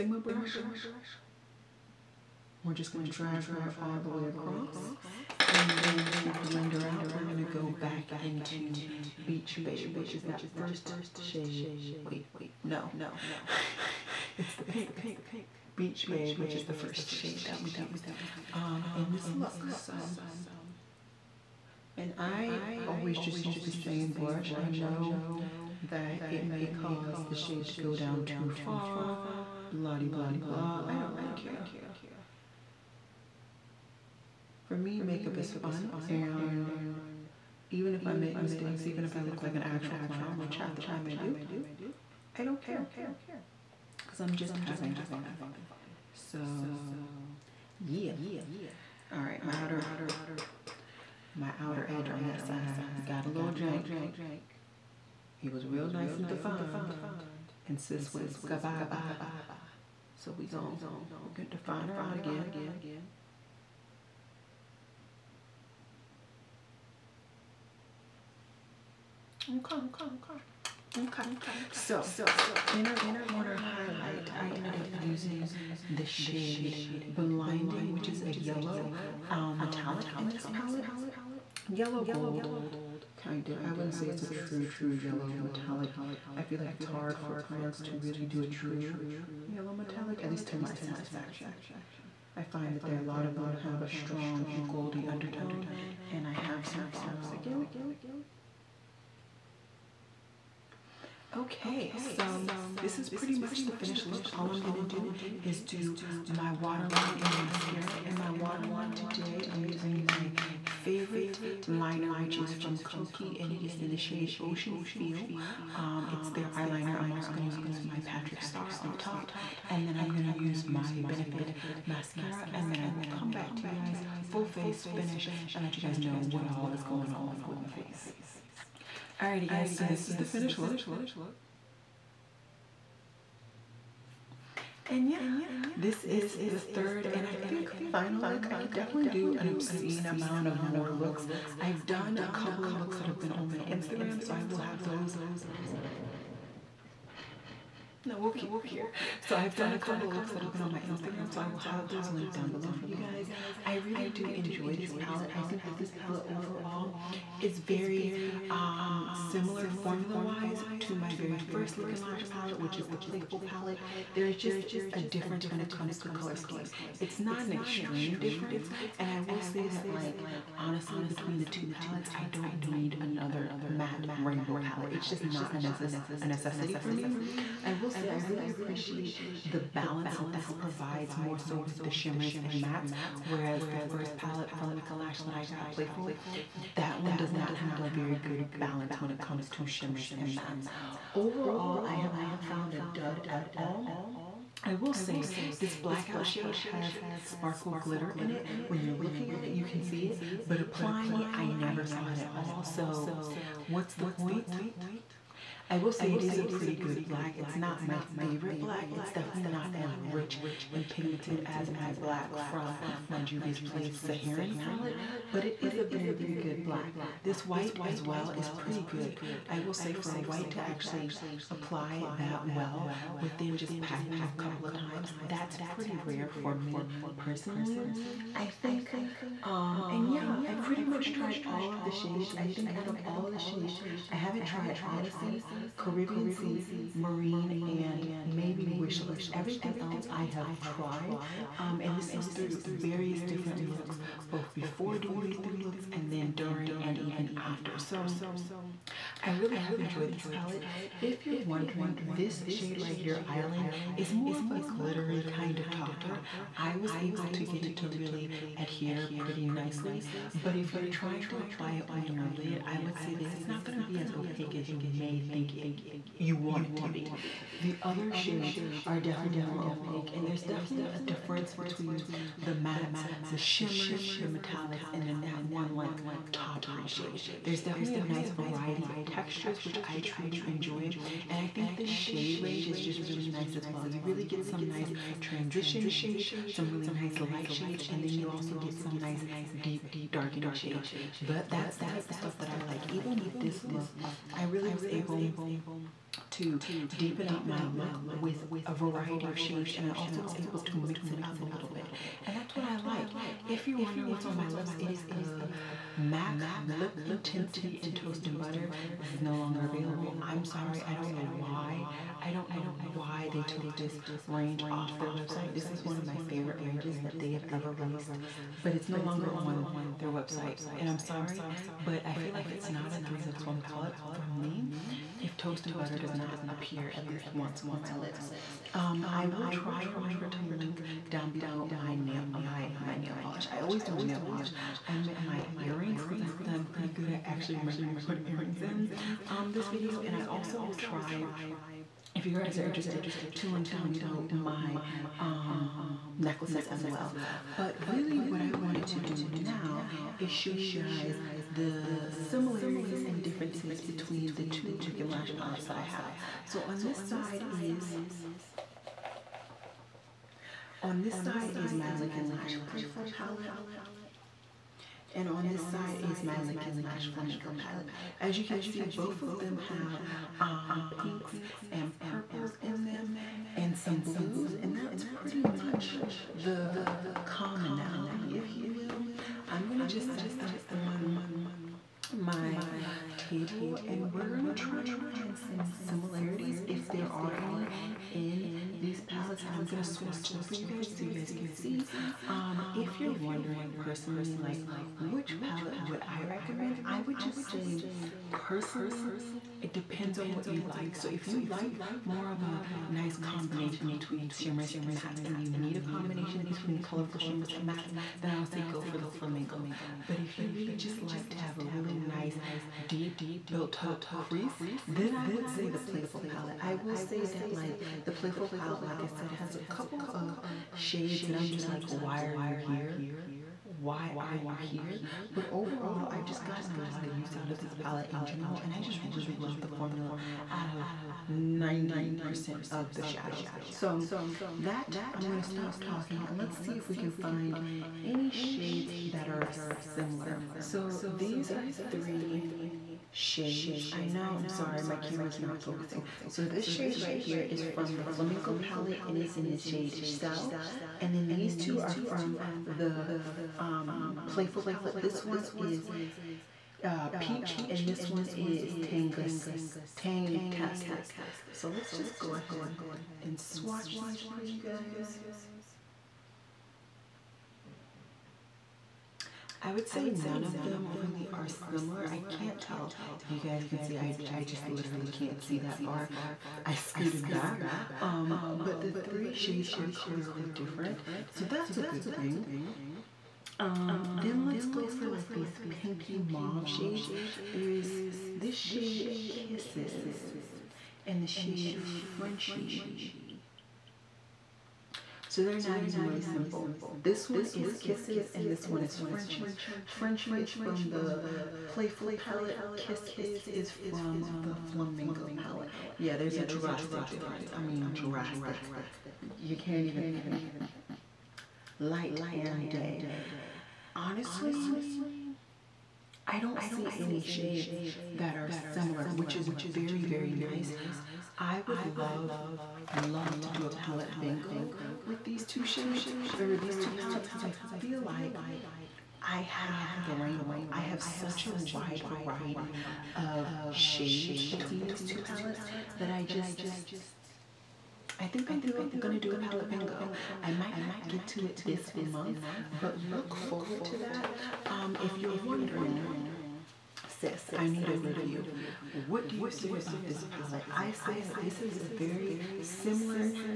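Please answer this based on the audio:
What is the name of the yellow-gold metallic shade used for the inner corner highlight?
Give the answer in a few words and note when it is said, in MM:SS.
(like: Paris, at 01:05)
Blinding, at 01:17.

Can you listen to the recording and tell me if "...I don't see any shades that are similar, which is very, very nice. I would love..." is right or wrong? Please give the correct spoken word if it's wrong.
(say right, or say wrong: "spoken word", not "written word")
right.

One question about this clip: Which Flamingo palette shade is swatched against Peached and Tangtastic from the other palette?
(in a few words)
Shell.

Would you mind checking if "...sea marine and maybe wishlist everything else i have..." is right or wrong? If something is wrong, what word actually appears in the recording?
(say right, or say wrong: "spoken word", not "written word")
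right.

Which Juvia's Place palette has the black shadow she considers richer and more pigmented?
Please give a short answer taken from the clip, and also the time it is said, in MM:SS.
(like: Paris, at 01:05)
Saharan, at 03:33.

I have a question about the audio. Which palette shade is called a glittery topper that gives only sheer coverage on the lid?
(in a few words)
Island.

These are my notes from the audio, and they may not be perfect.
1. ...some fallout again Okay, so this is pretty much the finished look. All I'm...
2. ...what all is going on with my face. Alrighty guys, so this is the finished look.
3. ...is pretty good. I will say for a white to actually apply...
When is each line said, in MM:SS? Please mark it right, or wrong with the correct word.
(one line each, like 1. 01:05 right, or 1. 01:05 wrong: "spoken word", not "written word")
1. 01:36 right
2. 02:06 right
3. 03:38 right.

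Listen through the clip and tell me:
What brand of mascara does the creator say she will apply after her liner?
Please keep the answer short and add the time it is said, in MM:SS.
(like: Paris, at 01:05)
Benefit, at 02:01.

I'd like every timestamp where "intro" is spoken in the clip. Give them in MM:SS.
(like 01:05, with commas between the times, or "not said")
not said.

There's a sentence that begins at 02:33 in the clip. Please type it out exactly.
I really do enjoy this palette.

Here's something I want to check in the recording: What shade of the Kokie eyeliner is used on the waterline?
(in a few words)
Ocean Feel.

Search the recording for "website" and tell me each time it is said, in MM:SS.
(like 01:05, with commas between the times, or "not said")
05:15, 05:20.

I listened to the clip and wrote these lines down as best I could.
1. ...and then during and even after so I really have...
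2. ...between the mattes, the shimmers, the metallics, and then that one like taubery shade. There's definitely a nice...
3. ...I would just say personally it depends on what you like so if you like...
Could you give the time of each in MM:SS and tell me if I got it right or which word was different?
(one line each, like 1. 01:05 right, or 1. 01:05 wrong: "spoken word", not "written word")
1. 04:05 right
2. 04:31 right
3. 06:36 right.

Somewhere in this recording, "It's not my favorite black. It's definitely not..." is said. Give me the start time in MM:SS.
03:27.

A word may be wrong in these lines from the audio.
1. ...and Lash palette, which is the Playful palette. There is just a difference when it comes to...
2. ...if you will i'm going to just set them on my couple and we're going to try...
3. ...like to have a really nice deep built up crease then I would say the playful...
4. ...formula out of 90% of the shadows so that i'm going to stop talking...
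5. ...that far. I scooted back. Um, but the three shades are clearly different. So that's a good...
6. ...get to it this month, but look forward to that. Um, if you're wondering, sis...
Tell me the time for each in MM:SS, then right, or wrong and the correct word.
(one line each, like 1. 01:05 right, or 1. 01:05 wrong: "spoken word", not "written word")
1. 02:41 right
2. 06:18 wrong: "table", not "couple"
3. 06:51 right
4. 07:09 right
5. 07:55 right
6. 09:01 right.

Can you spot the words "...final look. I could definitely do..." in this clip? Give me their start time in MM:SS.
02:17.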